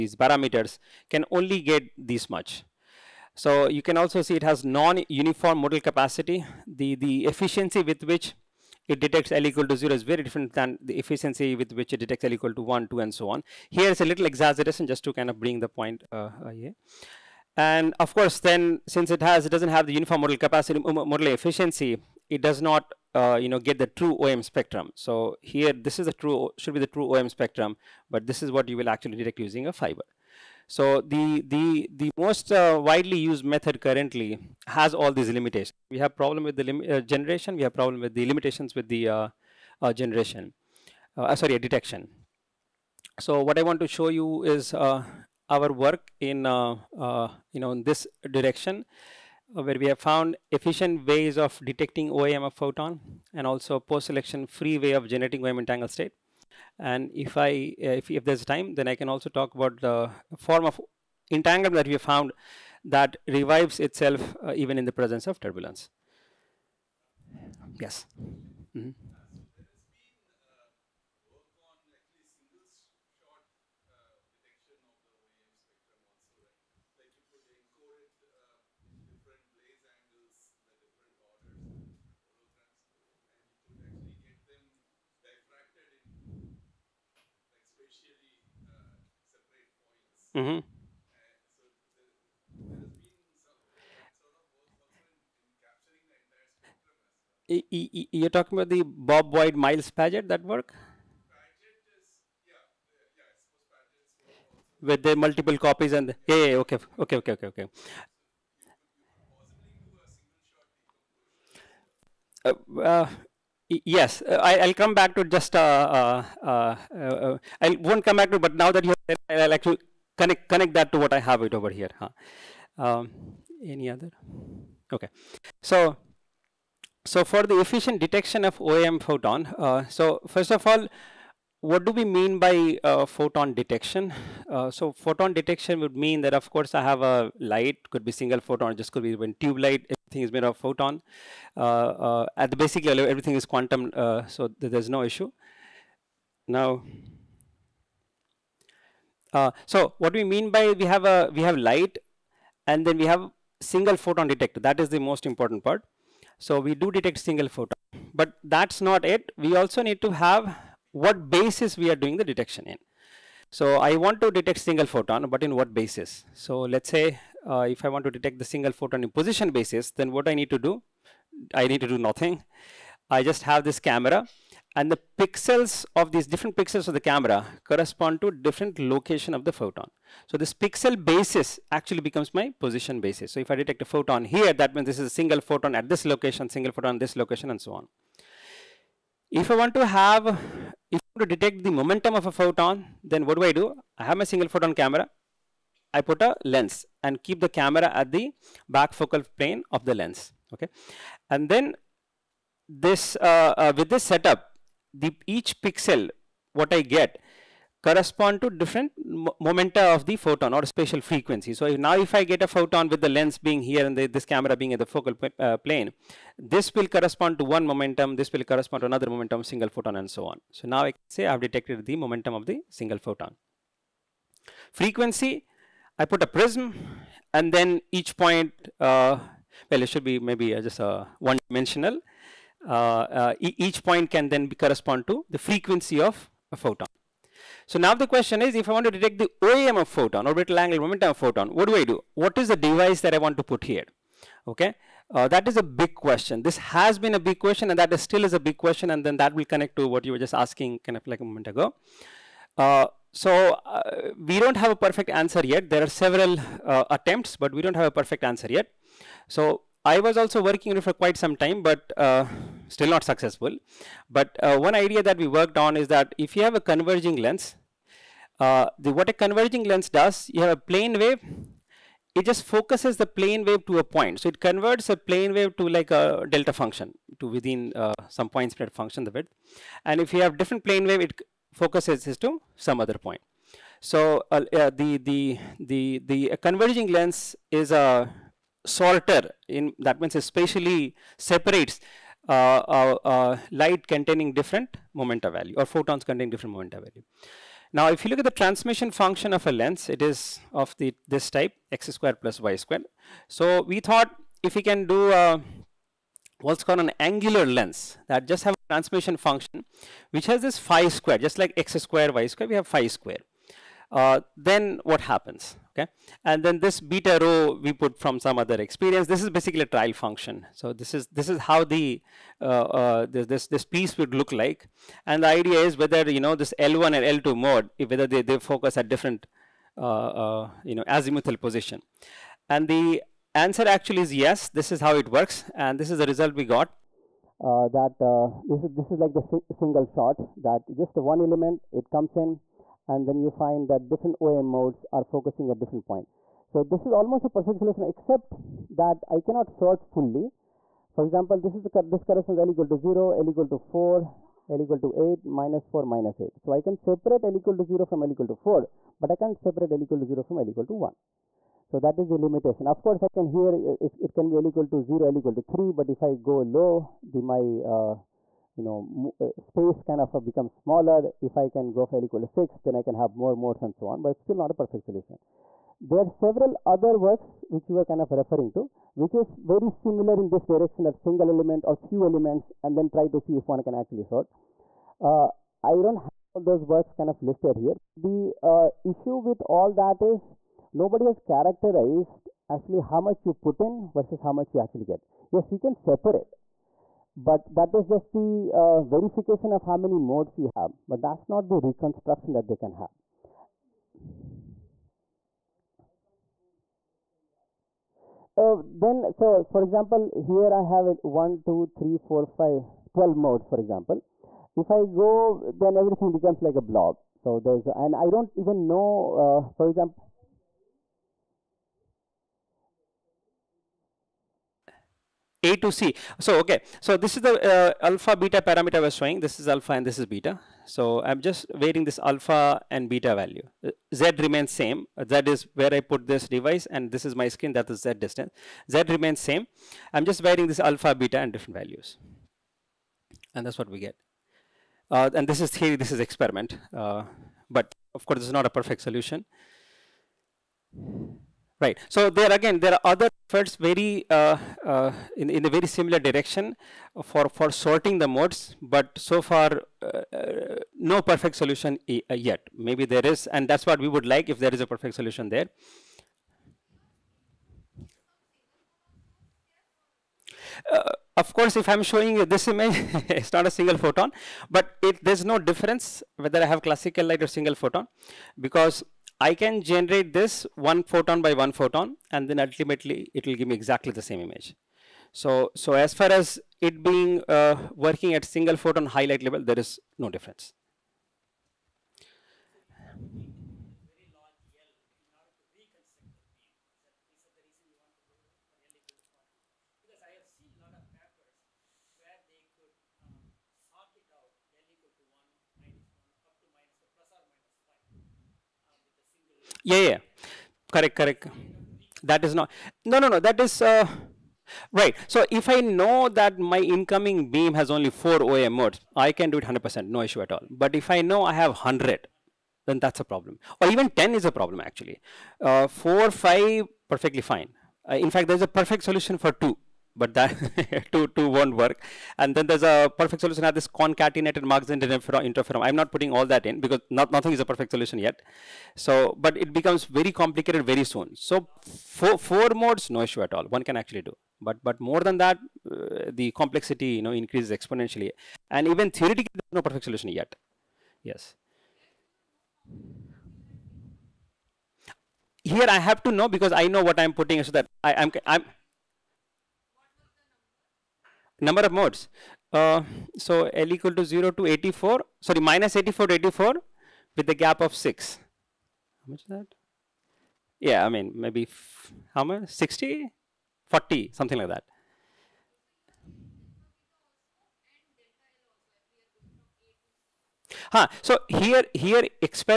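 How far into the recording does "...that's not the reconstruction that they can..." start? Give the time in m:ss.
6:41.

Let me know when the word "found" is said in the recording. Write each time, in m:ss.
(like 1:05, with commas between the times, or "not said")
0:49, 1:01.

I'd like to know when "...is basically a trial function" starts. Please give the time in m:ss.
5:19.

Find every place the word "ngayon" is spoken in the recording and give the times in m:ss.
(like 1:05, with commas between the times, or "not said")
not said.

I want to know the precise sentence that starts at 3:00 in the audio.
So this pixel basis actually becomes my position basis.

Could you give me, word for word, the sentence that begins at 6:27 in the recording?
The uh, issue with all that is nobody has characterized actually how much you put in versus how much you actually get.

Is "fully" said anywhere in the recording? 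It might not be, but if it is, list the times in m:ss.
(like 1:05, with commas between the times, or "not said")
5:49.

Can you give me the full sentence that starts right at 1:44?
With the multiple copies and the, yeah, okay, okay, okay, okay, okay.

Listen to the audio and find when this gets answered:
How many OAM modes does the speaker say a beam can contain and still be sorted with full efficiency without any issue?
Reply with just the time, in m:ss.
8:37.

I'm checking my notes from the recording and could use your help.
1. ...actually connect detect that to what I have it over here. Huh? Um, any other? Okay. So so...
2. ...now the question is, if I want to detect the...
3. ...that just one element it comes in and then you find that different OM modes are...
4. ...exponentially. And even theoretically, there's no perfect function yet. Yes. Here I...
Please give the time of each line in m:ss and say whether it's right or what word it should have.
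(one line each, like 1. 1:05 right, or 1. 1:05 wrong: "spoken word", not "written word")
1. 1:59 wrong: "connect", not "detect"
2. 3:57 right
3. 5:40 right
4. 9:07 wrong: "solution", not "function".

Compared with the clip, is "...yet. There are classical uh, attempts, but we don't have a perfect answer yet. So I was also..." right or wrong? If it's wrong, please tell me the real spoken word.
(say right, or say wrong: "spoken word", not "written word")
wrong: "several", not "classical".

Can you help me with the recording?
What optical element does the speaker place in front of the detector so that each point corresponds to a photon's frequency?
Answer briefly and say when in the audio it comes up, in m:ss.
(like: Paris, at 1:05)
a prism, at 3:46.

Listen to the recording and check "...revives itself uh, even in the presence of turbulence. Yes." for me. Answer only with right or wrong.
right.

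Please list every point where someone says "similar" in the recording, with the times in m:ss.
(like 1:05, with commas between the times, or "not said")
6:19, 7:35.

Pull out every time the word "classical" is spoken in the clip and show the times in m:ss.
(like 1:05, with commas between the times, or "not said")
7:56.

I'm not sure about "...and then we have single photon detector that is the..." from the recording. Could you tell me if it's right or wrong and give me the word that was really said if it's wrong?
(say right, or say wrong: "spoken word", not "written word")
right.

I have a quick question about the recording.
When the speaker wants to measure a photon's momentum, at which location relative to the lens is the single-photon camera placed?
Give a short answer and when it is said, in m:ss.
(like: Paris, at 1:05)
back focal plane, at 3:18.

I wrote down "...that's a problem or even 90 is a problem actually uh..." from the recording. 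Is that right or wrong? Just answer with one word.
wrong.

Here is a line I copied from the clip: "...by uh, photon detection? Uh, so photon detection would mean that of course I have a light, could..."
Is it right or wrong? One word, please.
right.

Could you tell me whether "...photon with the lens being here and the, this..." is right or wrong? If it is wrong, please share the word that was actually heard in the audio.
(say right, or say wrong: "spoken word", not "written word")
right.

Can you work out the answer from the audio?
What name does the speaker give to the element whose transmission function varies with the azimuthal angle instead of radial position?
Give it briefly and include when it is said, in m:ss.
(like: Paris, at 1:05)
angular lens, at 5:06.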